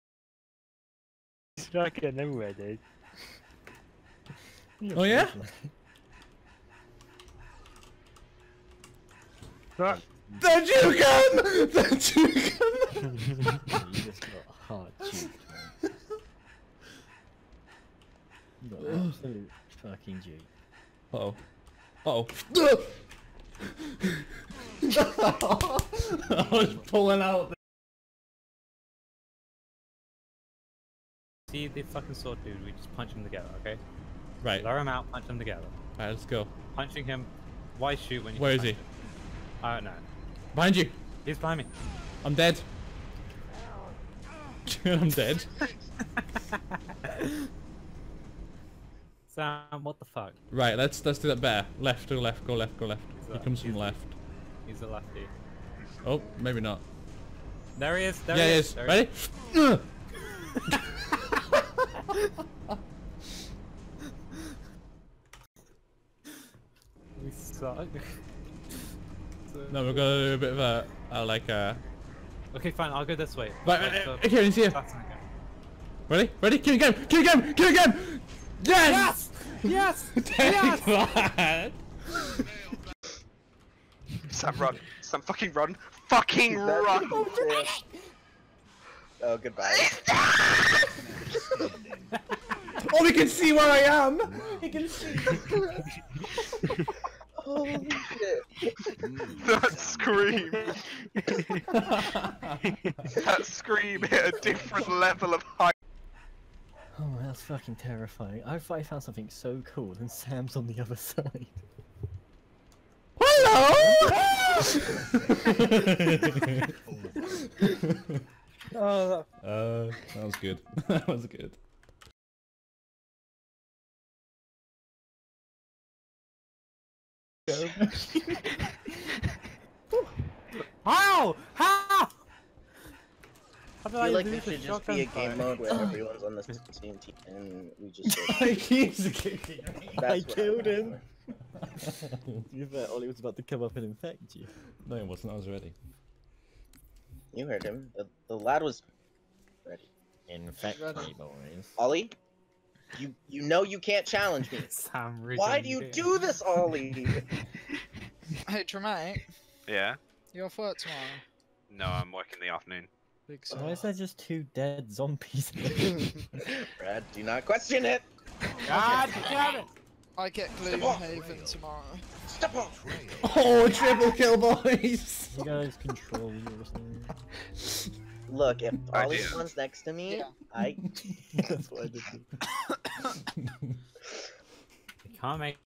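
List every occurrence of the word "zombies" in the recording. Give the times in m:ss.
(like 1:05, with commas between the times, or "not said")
2:44.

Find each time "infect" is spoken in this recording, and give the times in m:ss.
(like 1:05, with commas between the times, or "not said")
2:23, 2:30.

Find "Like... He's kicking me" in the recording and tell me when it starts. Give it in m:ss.
2:18.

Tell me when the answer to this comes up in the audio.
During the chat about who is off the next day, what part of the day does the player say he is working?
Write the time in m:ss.
2:42.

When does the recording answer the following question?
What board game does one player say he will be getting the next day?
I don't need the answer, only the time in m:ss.
2:50.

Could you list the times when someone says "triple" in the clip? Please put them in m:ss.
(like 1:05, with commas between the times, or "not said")
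2:53.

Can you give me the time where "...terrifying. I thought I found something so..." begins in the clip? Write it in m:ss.
1:47.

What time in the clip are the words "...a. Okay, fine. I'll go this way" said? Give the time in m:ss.
1:11.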